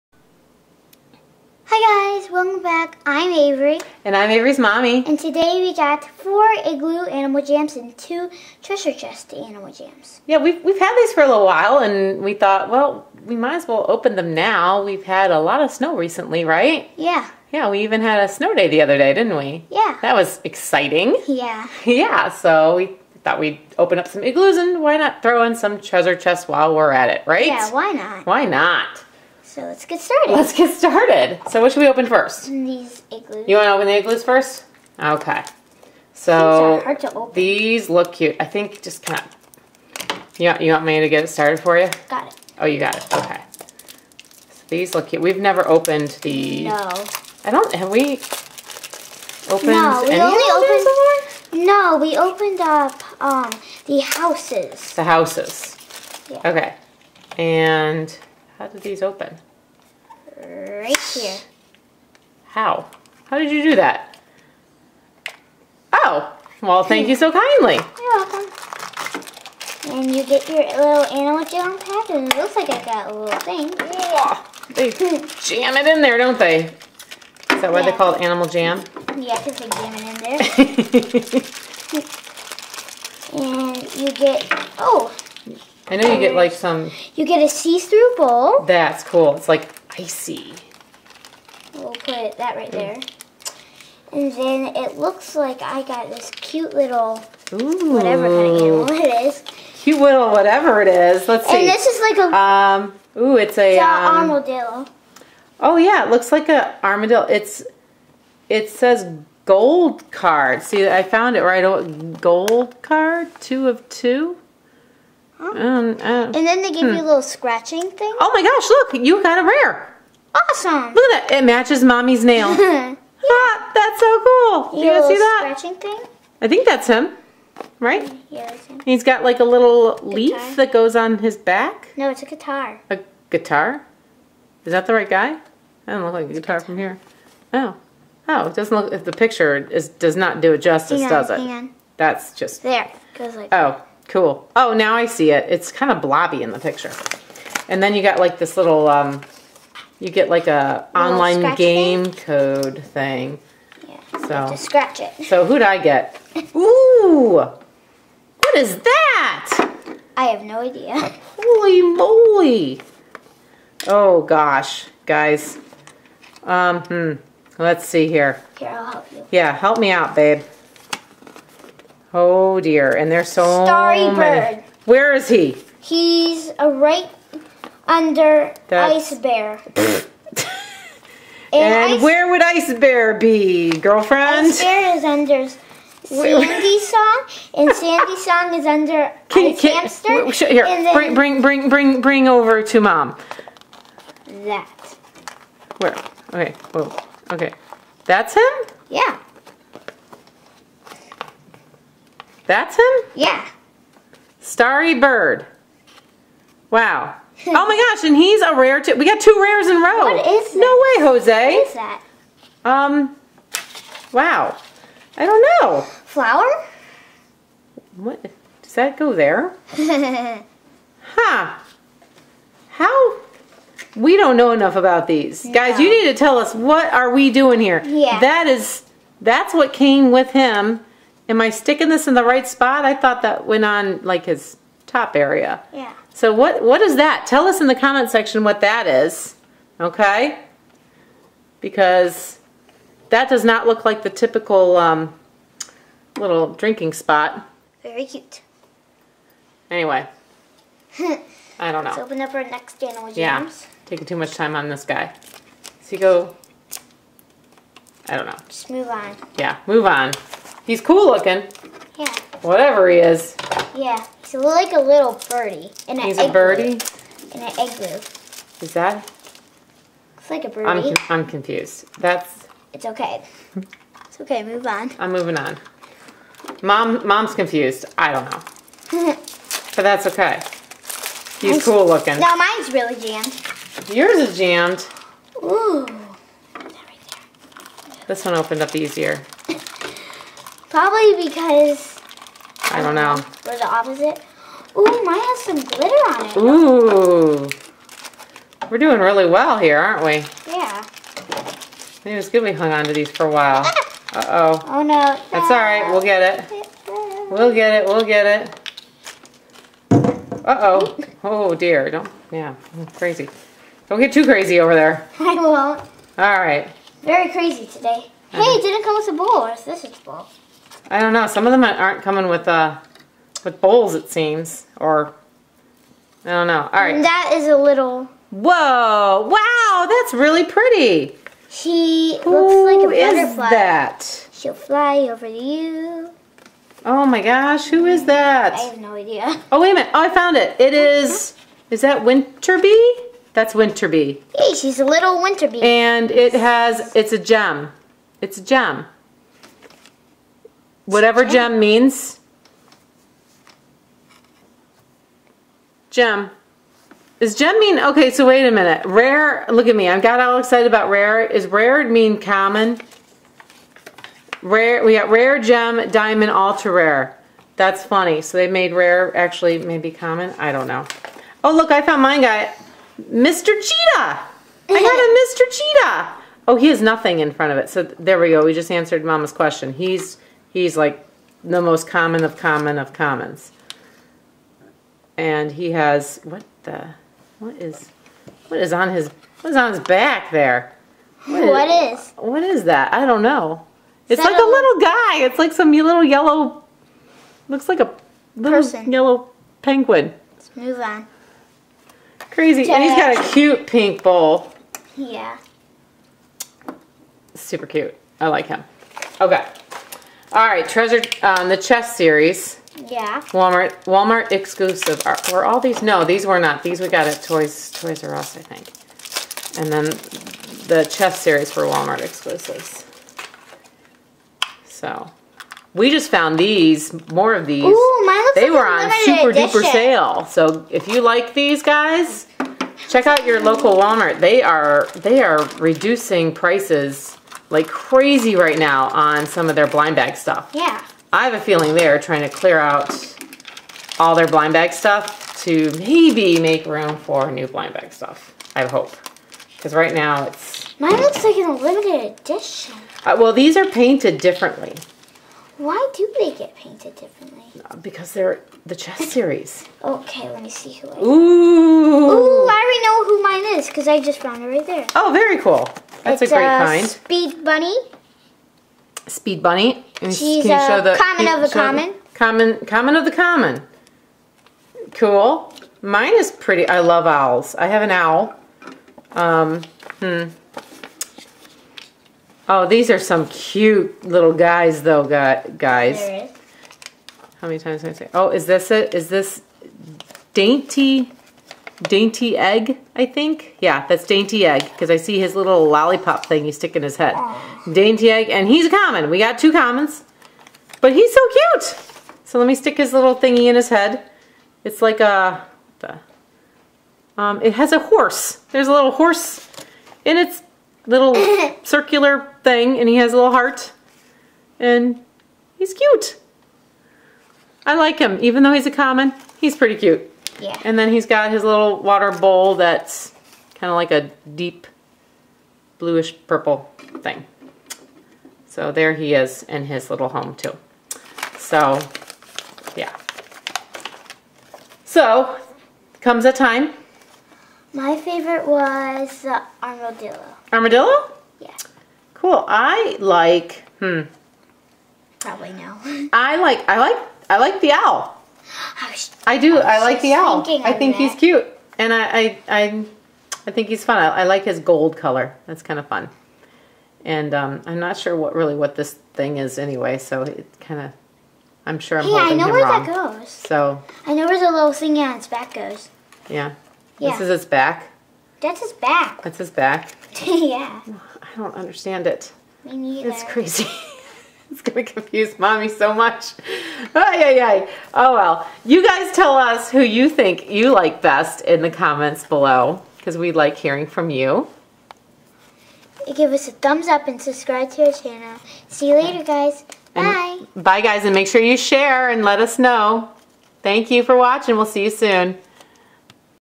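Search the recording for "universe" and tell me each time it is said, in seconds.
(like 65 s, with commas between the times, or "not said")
not said.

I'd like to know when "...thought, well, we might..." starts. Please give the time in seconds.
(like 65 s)
12 s.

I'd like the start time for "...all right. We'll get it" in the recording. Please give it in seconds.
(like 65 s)
305 s.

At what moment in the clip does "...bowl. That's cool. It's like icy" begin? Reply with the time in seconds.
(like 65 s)
88 s.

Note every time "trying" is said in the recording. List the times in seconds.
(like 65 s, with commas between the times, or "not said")
441 s.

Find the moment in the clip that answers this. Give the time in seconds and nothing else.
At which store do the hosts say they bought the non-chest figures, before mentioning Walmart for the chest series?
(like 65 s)
417 s.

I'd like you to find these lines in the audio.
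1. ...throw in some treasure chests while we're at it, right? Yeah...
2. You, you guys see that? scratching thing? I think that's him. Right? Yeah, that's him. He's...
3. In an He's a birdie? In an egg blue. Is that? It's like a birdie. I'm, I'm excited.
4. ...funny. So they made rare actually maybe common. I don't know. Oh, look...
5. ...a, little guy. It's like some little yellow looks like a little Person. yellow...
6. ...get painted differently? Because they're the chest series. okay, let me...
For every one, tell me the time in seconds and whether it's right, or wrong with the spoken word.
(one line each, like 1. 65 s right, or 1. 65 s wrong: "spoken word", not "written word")
1. 25 s right
2. 124 s right
3. 265 s wrong: "confused", not "excited"
4. 367 s right
5. 394 s right
6. 456 s right.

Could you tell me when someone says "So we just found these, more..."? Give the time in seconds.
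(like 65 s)
424 s.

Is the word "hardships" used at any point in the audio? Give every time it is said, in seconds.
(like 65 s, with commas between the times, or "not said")
not said.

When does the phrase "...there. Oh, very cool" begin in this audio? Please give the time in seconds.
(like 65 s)
464 s.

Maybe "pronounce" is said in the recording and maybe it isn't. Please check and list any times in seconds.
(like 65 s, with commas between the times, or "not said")
not said.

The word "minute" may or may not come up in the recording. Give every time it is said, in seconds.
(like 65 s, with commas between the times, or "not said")
339 s, 358 s.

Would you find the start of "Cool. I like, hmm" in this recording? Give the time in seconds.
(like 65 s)
542 s.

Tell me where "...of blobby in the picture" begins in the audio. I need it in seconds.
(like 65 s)
145 s.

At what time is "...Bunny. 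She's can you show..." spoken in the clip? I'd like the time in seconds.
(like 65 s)
469 s.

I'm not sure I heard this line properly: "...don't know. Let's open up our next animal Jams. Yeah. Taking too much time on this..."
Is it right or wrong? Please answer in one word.
right.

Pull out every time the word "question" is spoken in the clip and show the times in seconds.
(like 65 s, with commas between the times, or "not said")
379 s.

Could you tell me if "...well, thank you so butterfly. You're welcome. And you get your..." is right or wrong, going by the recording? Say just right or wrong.
wrong.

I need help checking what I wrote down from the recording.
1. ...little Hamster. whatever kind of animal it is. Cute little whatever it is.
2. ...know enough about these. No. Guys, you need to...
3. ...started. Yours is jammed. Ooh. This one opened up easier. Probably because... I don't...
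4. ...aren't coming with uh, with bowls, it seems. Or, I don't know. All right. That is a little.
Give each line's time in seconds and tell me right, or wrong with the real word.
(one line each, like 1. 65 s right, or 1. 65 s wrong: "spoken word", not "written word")
1. 96 s wrong: "Ooh", not "Hamster"
2. 224 s right
3. 283 s wrong: "jammed", not "started"
4. 321 s right.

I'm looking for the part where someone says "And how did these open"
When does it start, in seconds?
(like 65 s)
57 s.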